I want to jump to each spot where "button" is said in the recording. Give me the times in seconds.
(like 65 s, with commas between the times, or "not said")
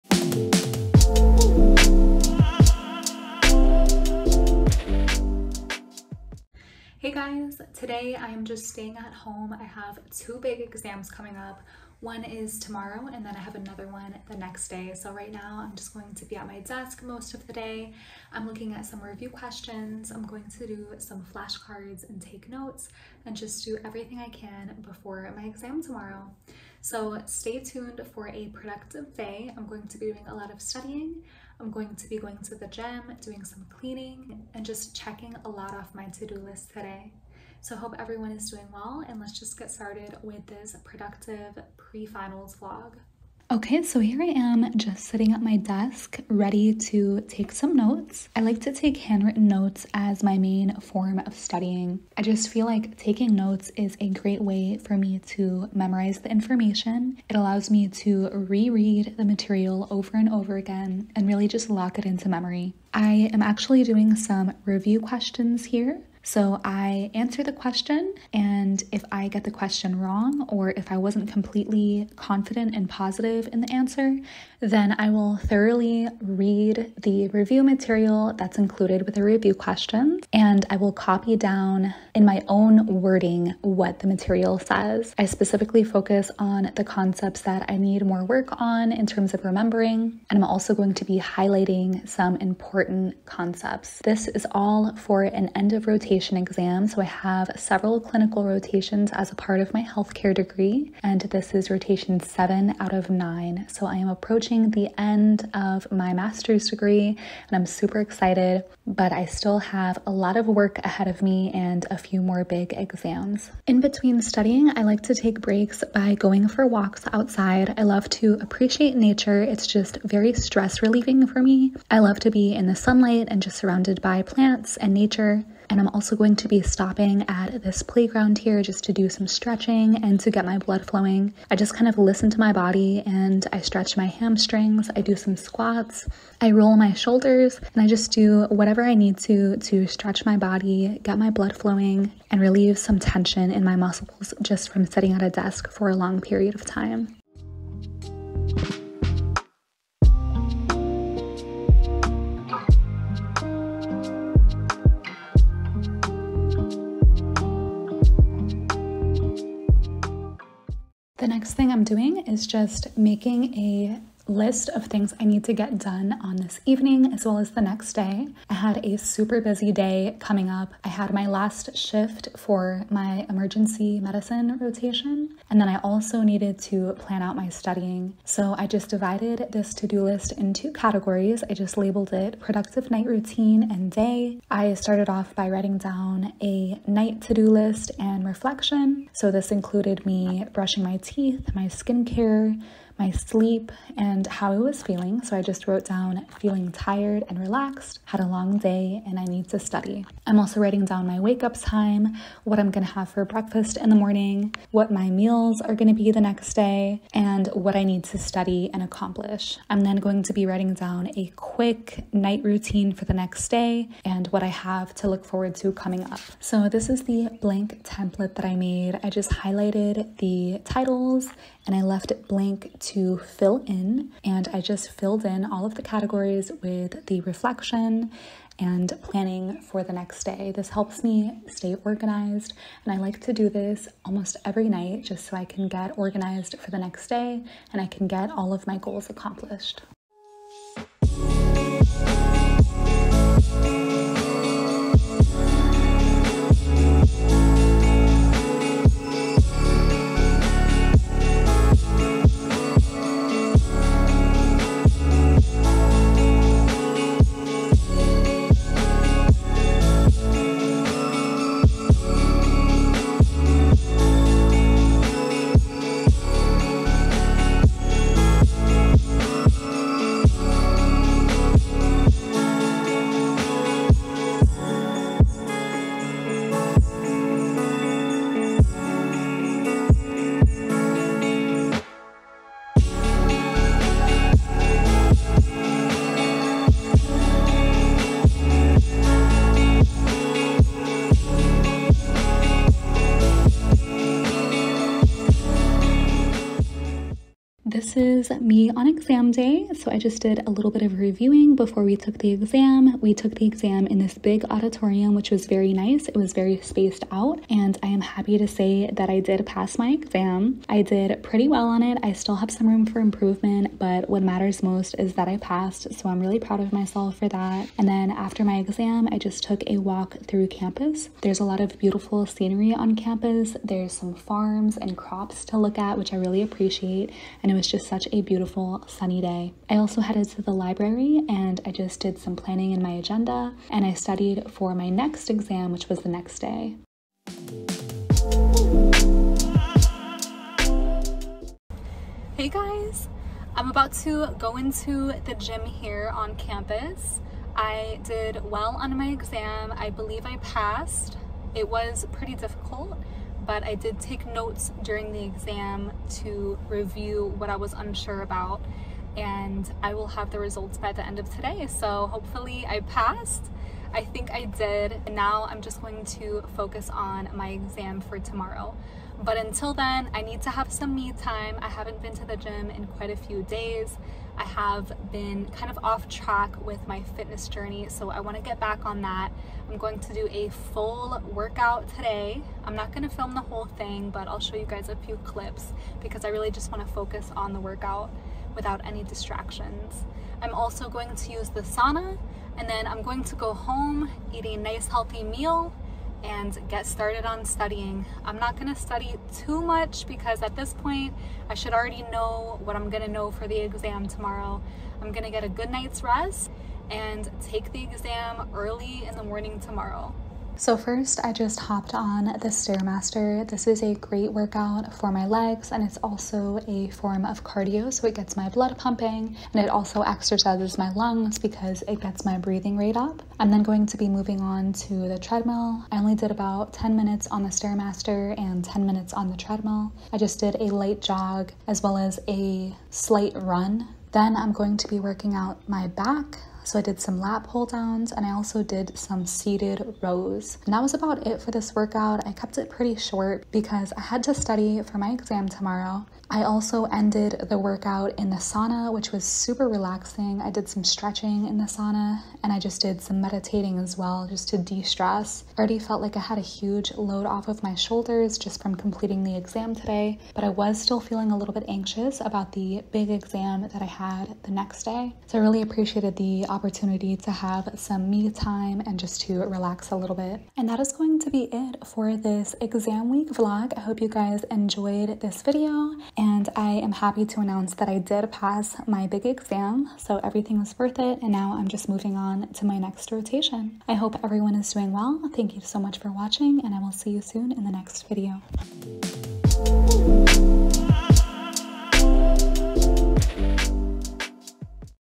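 not said.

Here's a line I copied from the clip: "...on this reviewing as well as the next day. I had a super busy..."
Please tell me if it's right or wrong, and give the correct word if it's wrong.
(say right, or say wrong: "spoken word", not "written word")
wrong: "evening", not "reviewing".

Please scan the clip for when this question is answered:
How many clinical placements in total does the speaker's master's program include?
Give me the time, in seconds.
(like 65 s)
102 s.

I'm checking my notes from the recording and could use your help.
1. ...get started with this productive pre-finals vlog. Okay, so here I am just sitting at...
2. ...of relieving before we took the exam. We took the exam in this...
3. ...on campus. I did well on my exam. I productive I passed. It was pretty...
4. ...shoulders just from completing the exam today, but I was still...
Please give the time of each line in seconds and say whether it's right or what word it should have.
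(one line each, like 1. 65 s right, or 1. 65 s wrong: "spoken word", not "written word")
1. 39 s right
2. 300 s wrong: "reviewing", not "relieving"
3. 346 s wrong: "believe", not "productive"
4. 457 s right.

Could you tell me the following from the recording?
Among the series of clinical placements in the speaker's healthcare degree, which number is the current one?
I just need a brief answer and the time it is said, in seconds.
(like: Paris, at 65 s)
7, at 101 s.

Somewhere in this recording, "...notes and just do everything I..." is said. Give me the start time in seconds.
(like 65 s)
22 s.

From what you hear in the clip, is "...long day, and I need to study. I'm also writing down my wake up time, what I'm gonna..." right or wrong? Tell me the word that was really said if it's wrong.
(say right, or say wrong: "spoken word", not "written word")
right.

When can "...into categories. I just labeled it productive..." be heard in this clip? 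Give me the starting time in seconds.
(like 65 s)
180 s.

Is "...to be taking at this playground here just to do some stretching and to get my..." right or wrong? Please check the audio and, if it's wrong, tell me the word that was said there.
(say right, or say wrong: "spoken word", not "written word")
wrong: "stopping", not "taking".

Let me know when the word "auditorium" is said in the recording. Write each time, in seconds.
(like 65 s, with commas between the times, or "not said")
304 s.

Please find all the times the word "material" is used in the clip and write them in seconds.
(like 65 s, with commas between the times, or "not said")
59 s, 77 s, 84 s.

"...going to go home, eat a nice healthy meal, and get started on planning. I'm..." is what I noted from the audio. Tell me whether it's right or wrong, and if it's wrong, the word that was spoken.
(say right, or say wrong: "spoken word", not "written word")
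wrong: "studying", not "planning".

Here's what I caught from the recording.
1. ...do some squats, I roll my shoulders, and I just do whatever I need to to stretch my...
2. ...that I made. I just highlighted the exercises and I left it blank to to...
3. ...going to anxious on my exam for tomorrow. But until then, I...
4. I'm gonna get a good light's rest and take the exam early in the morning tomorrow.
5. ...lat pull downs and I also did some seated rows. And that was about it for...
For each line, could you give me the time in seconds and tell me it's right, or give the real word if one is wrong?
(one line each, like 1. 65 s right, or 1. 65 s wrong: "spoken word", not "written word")
1. 134 s right
2. 218 s wrong: "titles", not "exercises"
3. 365 s wrong: "focus", not "anxious"
4. 405 s wrong: "night", not "light"
5. 437 s right.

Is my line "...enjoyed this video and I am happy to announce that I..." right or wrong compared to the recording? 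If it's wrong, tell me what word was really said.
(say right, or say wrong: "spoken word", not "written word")
right.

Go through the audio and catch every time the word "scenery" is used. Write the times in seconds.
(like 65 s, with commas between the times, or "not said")
322 s.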